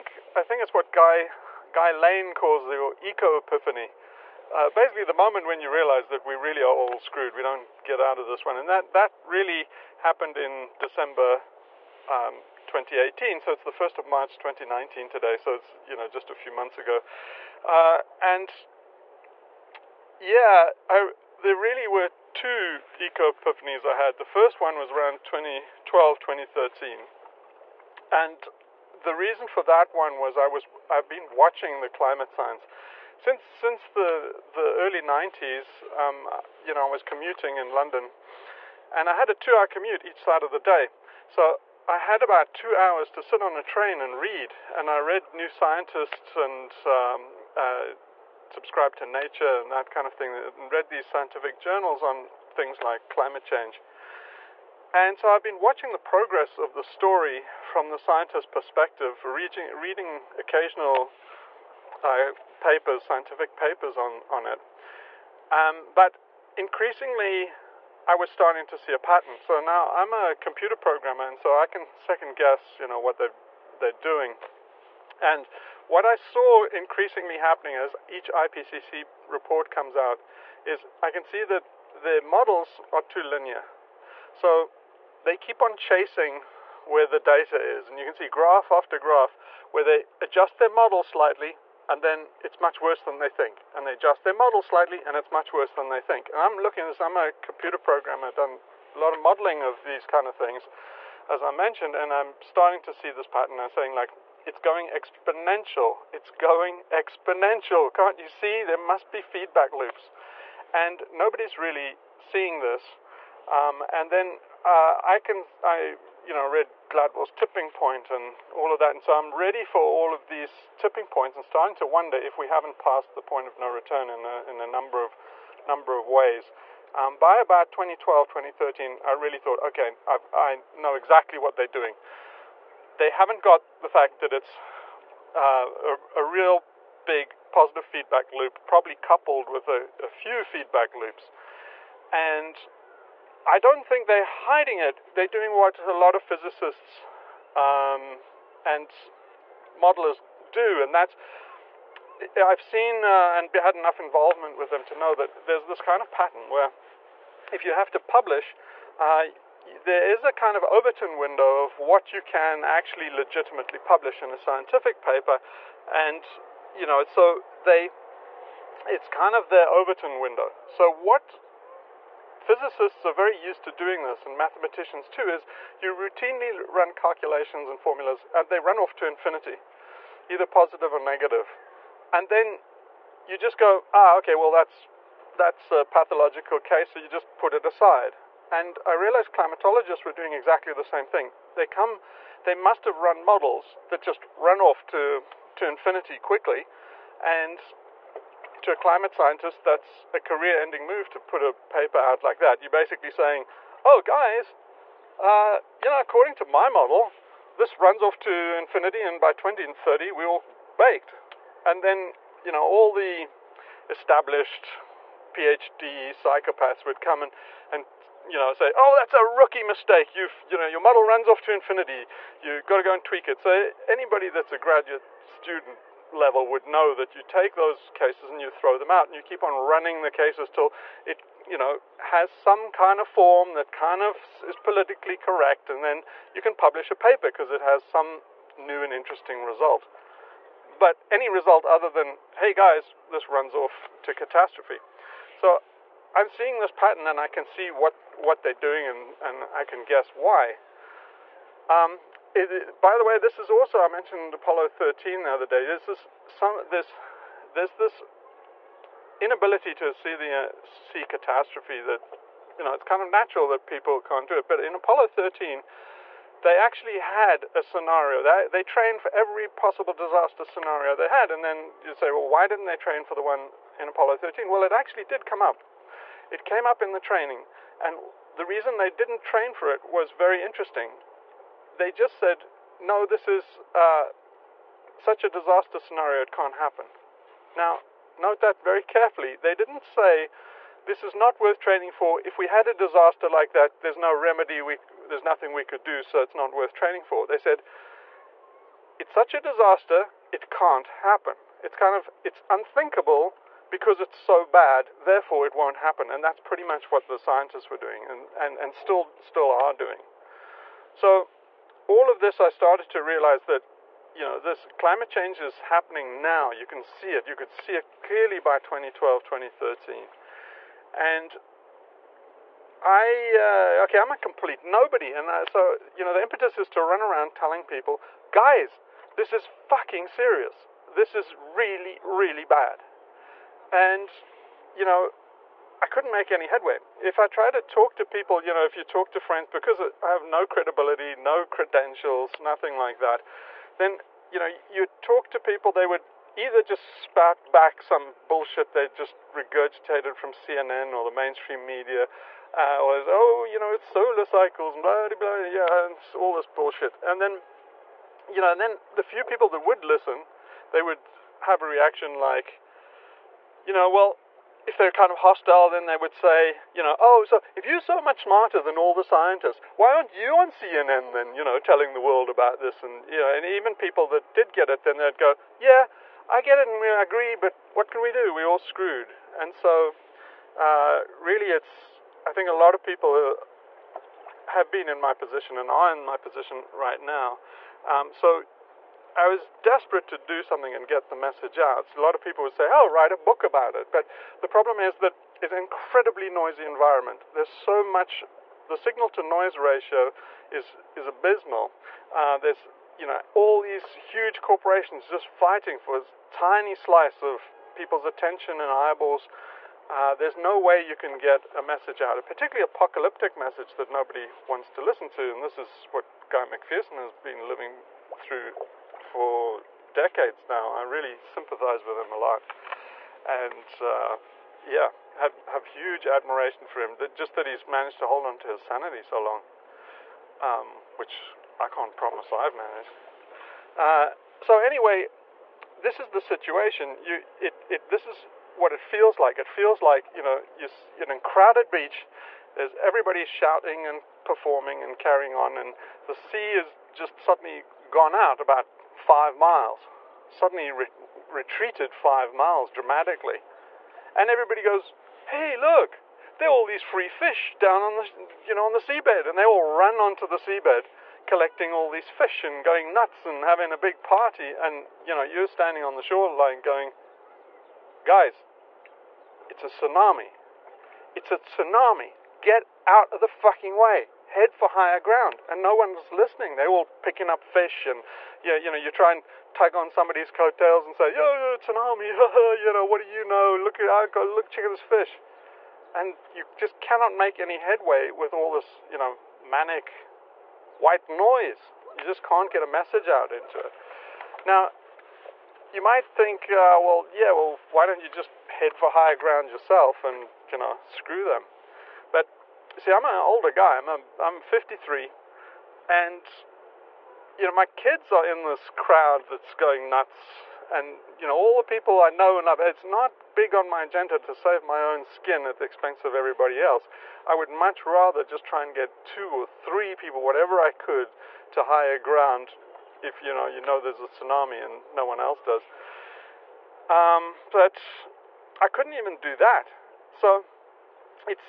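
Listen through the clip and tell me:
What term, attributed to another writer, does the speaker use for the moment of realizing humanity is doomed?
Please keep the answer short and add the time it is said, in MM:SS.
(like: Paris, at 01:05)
eco epiphany, at 00:03.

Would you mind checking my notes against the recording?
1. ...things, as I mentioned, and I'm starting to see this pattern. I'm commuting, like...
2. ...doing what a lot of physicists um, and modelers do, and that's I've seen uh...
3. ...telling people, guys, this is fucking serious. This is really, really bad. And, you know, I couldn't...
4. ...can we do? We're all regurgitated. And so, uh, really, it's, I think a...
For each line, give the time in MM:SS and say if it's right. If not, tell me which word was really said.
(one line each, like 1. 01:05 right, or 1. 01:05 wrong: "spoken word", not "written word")
1. 01:40 wrong: "saying", not "commuting"
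2. 02:25 right
3. 05:27 right
4. 06:17 wrong: "screwed", not "regurgitated".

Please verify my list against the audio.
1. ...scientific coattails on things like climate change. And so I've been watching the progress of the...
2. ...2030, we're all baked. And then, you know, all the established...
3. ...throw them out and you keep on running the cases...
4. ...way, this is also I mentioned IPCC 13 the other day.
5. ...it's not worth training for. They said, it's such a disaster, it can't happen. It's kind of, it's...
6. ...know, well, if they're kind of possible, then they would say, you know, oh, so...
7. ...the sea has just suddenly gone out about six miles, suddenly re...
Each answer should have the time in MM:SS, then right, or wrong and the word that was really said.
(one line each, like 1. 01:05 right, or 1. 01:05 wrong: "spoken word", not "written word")
1. 00:51 wrong: "journals", not "coattails"
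2. 03:29 right
3. 03:48 right
4. 04:13 wrong: "Apollo", not "IPCC"
5. 04:56 right
6. 06:03 wrong: "hostile", not "possible"
7. 07:26 wrong: "five", not "six".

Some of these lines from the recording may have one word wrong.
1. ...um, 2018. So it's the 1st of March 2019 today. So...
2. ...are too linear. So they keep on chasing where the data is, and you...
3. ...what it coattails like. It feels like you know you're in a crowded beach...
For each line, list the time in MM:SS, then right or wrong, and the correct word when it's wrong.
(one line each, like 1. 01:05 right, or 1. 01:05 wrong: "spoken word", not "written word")
1. 00:12 right
2. 01:22 right
3. 07:18 wrong: "feels", not "coattails".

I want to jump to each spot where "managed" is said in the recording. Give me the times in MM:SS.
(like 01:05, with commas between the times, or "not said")
07:07, 07:12.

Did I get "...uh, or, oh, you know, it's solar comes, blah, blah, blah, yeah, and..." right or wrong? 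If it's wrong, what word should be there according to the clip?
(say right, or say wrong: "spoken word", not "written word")
wrong: "cycles", not "comes".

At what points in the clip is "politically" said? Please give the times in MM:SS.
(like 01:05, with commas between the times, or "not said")
03:54.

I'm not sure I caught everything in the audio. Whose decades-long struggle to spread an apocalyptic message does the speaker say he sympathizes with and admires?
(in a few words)
Guy McPherson.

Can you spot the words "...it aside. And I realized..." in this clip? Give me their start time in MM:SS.
03:07.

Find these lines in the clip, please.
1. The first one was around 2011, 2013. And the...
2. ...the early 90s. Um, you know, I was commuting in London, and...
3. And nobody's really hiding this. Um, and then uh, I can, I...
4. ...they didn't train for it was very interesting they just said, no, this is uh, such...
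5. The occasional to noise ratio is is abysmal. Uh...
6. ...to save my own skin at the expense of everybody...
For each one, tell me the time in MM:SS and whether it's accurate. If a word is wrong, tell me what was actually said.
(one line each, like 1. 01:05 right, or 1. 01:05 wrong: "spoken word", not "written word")
1. 00:24 wrong: "2012", not "2011"
2. 00:34 right
3. 01:50 wrong: "seeing", not "hiding"
4. 04:38 right
5. 06:38 wrong: "signal", not "occasional"
6. 08:34 right.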